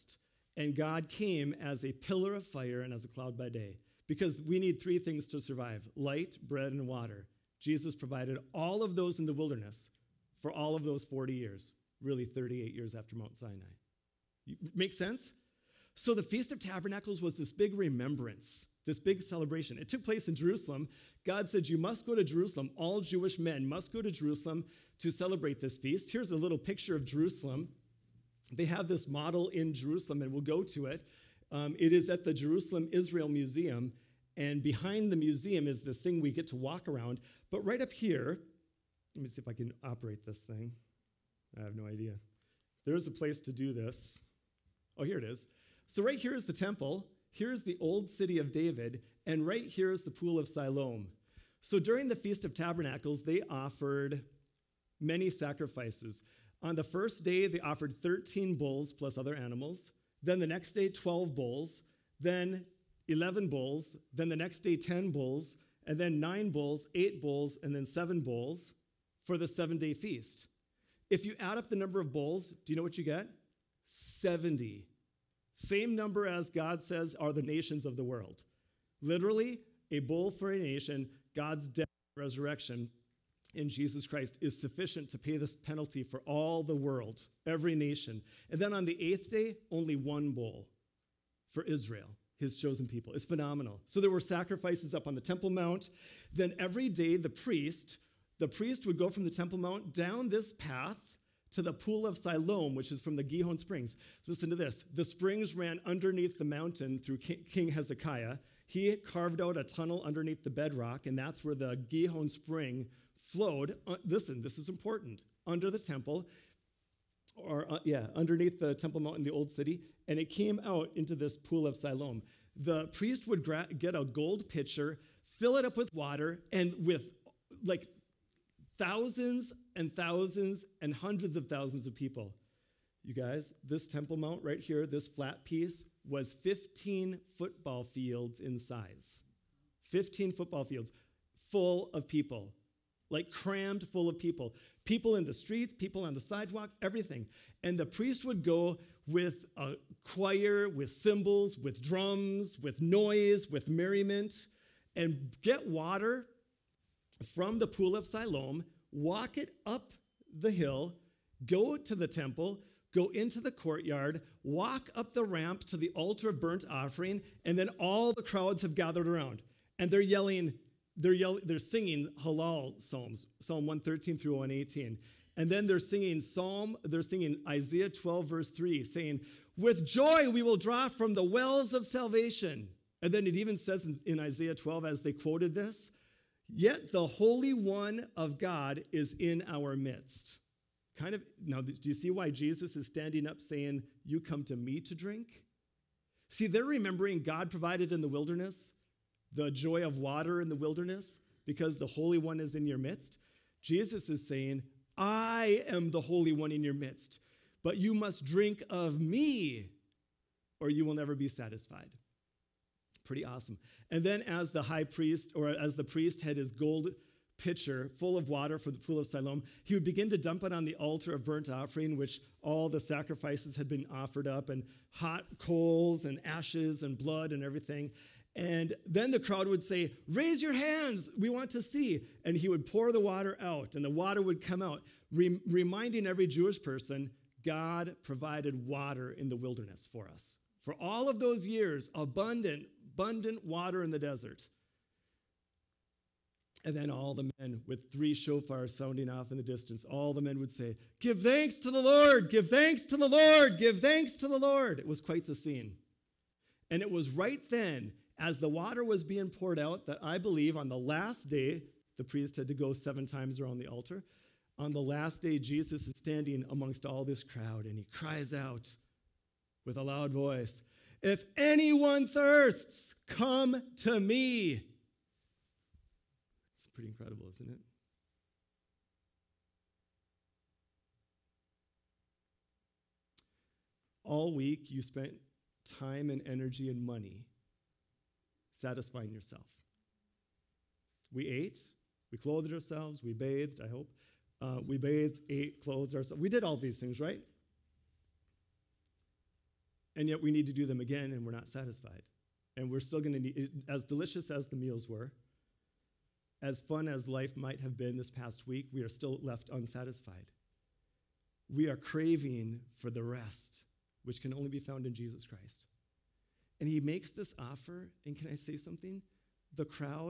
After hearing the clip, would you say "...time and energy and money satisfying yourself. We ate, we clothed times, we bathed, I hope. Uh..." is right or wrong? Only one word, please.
wrong.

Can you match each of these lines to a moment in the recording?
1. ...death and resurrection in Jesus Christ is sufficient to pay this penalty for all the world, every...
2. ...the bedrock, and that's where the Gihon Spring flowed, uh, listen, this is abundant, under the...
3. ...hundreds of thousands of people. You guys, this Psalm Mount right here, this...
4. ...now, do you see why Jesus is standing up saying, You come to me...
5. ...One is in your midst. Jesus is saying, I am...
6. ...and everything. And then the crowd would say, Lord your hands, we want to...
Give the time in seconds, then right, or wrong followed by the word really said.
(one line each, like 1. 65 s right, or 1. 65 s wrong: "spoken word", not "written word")
1. 81 s right
2. 110 s wrong: "important", not "abundant"
3. 130 s wrong: "Temple", not "Psalm"
4. 191 s right
5. 202 s right
6. 227 s wrong: "Raise", not "Lord".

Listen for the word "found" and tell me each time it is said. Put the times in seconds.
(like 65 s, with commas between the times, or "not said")
314 s.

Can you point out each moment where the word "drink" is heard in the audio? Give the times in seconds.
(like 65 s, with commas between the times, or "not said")
194 s, 208 s.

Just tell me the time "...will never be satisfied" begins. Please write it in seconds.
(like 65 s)
210 s.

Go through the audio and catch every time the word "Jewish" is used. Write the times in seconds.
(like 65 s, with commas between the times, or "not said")
23 s, 236 s.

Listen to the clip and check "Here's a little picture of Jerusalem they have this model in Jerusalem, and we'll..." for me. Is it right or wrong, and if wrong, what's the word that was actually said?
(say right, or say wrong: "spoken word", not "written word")
right.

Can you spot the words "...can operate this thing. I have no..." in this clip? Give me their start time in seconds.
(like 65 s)
39 s.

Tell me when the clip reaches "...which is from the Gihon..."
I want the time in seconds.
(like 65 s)
102 s.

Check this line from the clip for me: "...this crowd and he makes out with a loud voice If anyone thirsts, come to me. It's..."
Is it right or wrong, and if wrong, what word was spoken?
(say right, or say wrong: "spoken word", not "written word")
wrong: "cries", not "makes".